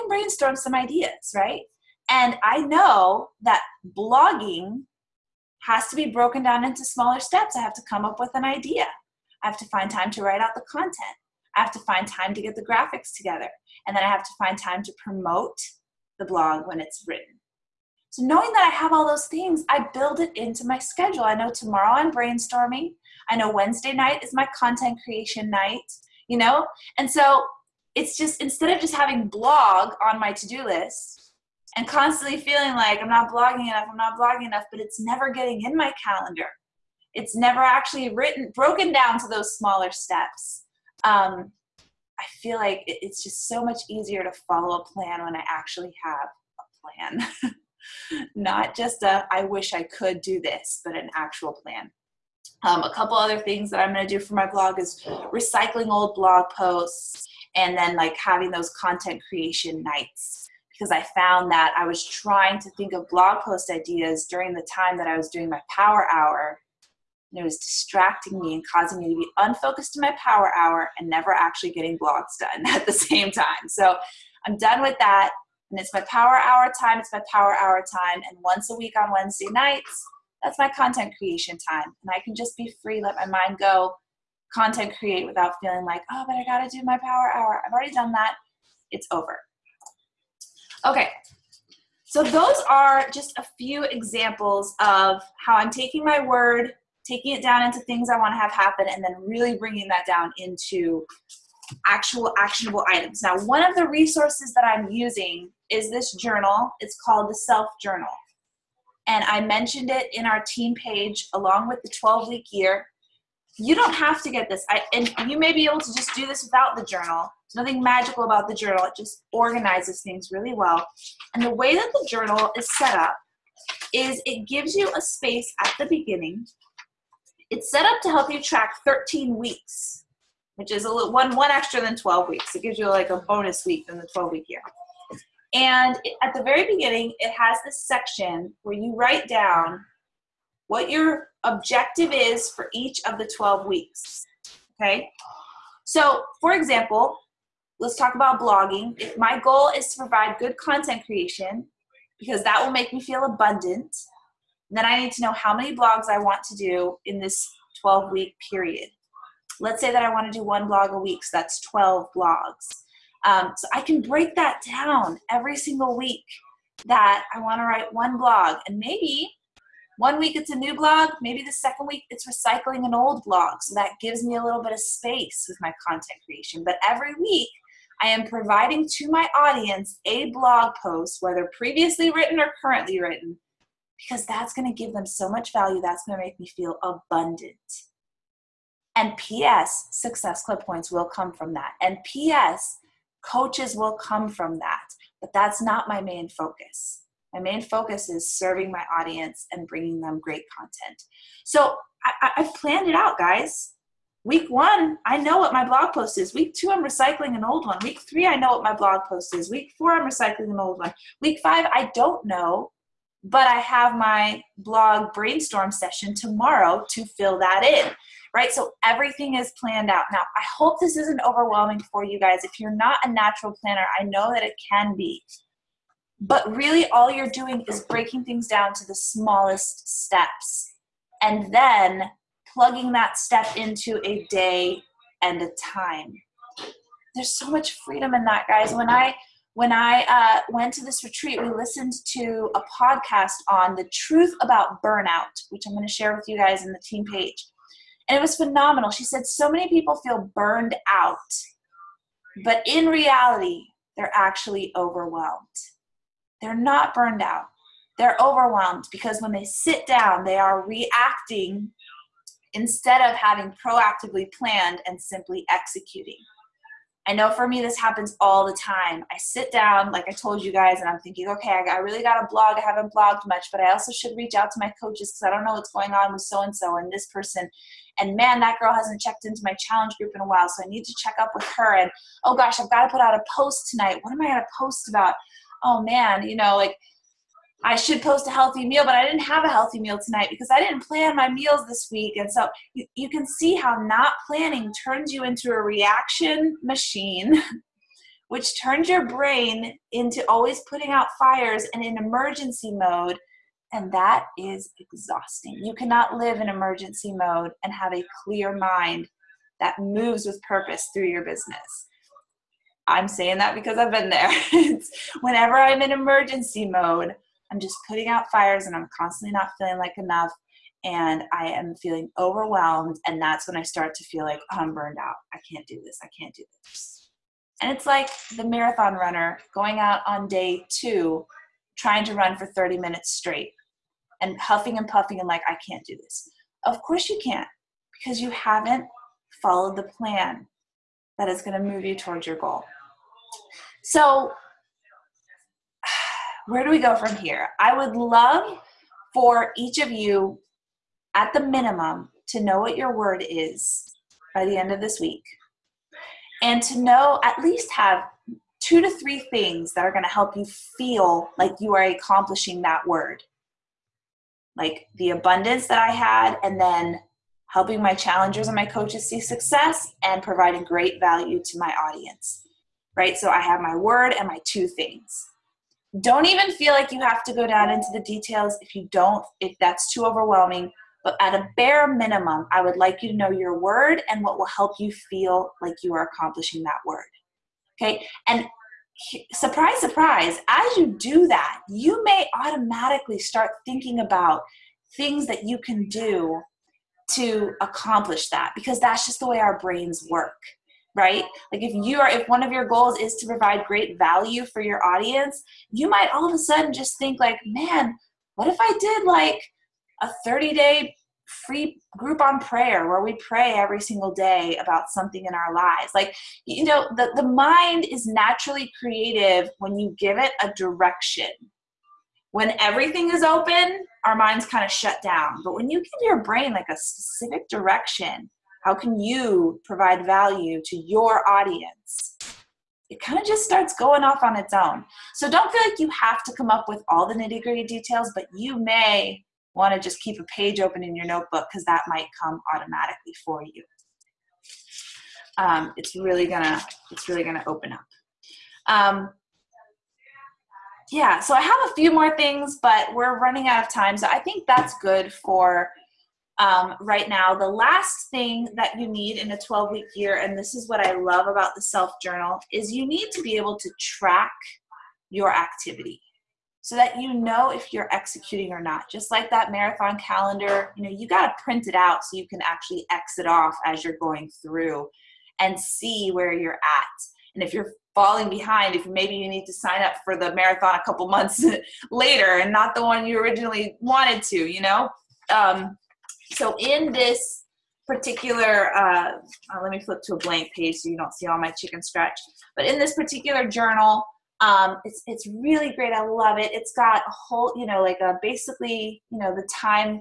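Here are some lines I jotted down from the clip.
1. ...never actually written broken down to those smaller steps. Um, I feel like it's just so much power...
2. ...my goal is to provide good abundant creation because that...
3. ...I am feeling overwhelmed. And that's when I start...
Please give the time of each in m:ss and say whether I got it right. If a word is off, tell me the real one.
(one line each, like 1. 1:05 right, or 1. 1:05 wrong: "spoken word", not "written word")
1. 0:37 wrong: "easier", not "power"
2. 2:29 wrong: "content", not "abundant"
3. 5:21 right.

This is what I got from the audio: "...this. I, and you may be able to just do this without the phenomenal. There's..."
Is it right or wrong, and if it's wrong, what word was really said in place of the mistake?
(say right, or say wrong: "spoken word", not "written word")
wrong: "journal", not "phenomenal".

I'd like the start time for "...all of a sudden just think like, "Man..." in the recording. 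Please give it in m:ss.
6:46.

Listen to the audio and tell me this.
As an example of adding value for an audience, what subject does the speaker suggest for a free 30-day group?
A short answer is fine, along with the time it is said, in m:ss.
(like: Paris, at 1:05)
prayer, at 6:52.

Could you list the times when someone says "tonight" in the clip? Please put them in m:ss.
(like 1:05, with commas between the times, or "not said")
4:43, 4:50.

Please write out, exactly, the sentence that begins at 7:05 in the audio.
But when you give your brain like a specific direction, how can you provide value to your audience?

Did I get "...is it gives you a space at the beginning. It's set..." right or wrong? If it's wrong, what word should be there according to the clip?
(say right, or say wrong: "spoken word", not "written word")
right.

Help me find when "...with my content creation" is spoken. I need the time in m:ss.
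2:55.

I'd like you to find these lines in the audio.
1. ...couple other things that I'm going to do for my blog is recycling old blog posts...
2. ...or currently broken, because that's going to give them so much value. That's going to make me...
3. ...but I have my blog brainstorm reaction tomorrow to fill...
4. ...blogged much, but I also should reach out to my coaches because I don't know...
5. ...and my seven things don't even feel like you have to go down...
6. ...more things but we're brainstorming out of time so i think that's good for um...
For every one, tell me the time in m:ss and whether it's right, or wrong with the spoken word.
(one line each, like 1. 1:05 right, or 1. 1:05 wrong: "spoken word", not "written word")
1. 0:52 right
2. 3:02 wrong: "written", not "broken"
3. 3:33 wrong: "session", not "reaction"
4. 4:32 right
5. 6:14 wrong: "two", not "seven"
6. 7:31 wrong: "running", not "brainstorming".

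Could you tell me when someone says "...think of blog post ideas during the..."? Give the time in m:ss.
1:02.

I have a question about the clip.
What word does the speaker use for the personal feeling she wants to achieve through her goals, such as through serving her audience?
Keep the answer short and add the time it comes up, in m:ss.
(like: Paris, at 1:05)
abundance, at 6:05.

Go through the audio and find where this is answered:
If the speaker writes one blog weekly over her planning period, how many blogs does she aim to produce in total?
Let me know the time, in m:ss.
2:41.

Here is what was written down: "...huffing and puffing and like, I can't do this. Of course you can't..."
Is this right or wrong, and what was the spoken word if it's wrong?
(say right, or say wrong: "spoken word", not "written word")
right.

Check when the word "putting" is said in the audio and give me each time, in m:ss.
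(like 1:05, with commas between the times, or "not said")
5:00, 5:17.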